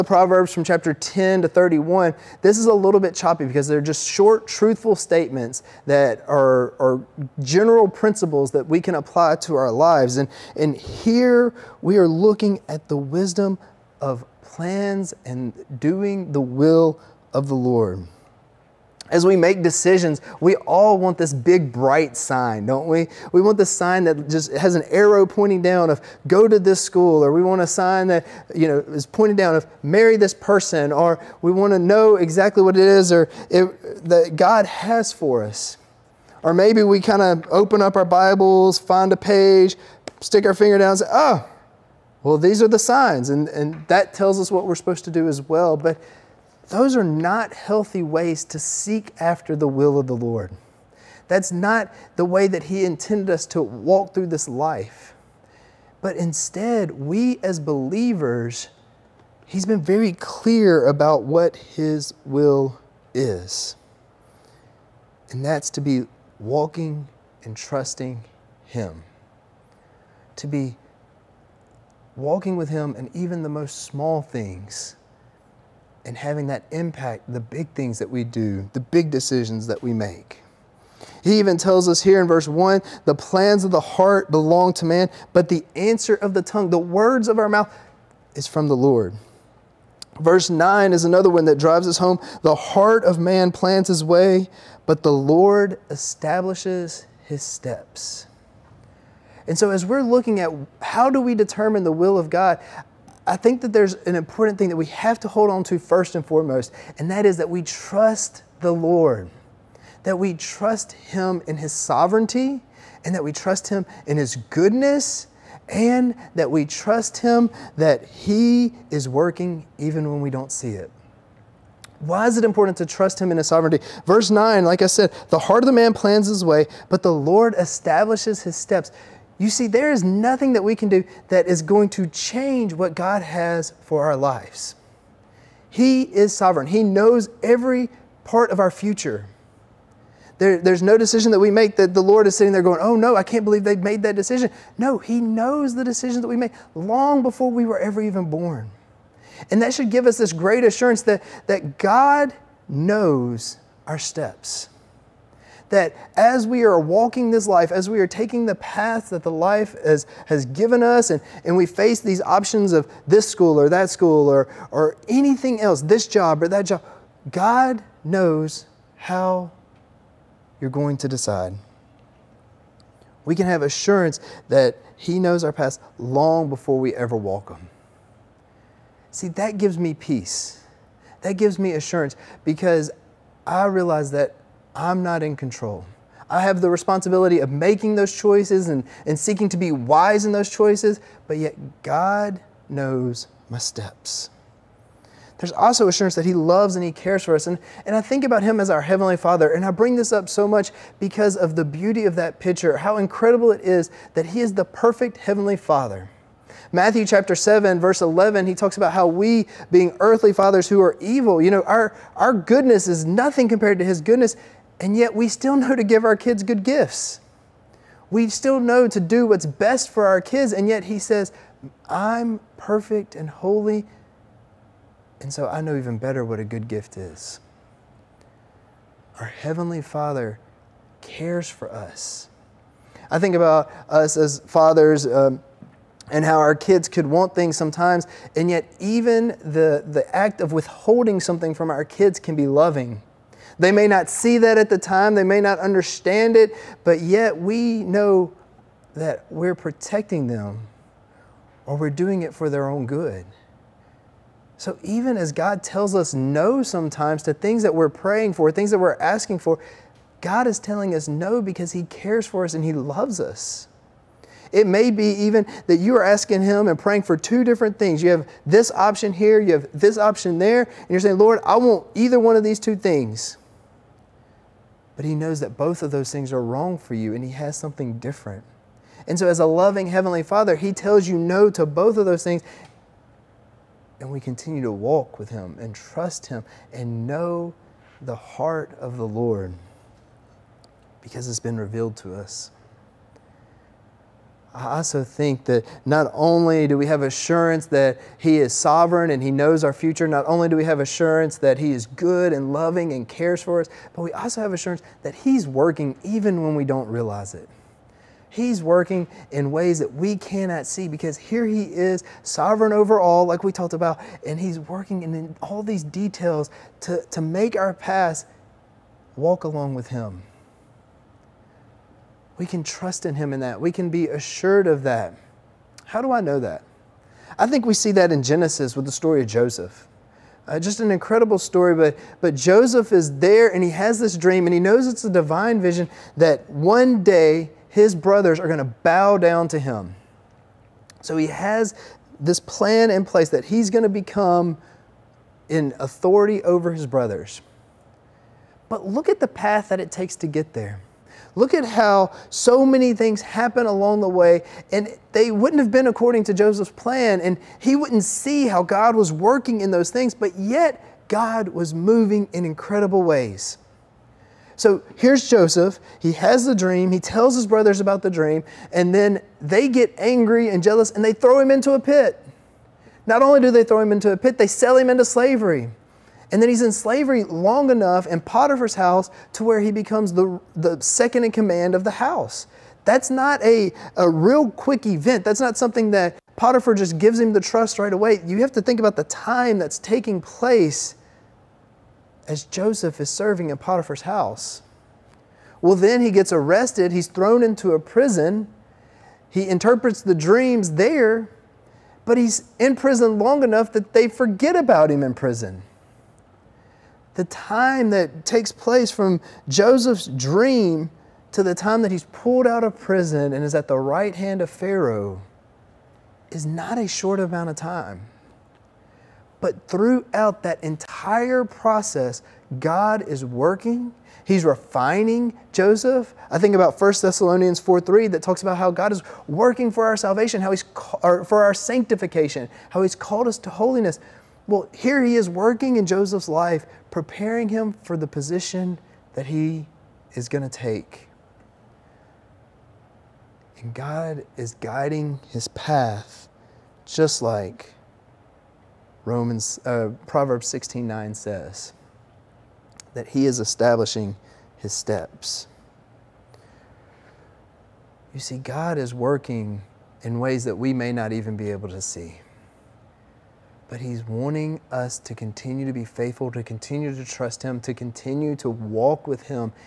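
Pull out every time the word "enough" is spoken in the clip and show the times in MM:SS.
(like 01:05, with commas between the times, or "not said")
06:17, 06:43.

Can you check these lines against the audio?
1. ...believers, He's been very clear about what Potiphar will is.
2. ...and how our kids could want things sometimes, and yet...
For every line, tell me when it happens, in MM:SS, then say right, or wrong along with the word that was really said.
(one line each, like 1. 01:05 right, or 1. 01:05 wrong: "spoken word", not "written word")
1. 00:57 wrong: "His", not "Potiphar"
2. 03:56 right.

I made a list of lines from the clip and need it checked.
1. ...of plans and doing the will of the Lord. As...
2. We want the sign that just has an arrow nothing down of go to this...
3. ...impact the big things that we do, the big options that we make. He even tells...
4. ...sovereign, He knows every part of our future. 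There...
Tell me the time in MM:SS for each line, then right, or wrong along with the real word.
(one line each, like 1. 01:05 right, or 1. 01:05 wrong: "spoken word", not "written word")
1. 00:13 right
2. 00:23 wrong: "pointing", not "nothing"
3. 01:16 wrong: "decisions", not "options"
4. 02:16 right.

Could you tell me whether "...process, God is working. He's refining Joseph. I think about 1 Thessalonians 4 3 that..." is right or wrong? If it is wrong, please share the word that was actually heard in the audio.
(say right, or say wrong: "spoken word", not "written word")
right.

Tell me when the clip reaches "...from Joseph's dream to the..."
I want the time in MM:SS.
06:48.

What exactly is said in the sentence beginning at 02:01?
Why is it important to trust Him in His sovereignty?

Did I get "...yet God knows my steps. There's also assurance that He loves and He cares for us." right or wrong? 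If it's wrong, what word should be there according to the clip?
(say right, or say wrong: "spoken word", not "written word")
right.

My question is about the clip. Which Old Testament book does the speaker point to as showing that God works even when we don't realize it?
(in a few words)
Genesis.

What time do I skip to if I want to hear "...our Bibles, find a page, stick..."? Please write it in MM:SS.
00:37.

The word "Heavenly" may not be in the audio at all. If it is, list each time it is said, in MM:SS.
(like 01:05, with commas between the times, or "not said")
03:18, 03:25, 03:49, 04:39.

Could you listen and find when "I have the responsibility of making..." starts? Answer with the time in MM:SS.
03:06.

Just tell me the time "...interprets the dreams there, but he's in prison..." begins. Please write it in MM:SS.
06:39.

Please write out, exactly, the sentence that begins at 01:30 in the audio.
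Verse 9 is another one that drives us home.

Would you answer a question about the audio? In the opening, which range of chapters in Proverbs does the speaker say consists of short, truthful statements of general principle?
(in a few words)
10 to 31.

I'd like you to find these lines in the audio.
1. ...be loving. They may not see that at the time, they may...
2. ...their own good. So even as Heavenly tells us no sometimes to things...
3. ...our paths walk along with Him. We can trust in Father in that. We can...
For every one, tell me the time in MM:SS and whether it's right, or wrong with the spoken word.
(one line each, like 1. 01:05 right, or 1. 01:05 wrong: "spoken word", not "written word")
1. 04:02 right
2. 04:12 wrong: "God", not "Heavenly"
3. 05:17 wrong: "Him", not "Father".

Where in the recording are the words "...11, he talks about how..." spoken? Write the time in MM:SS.
03:27.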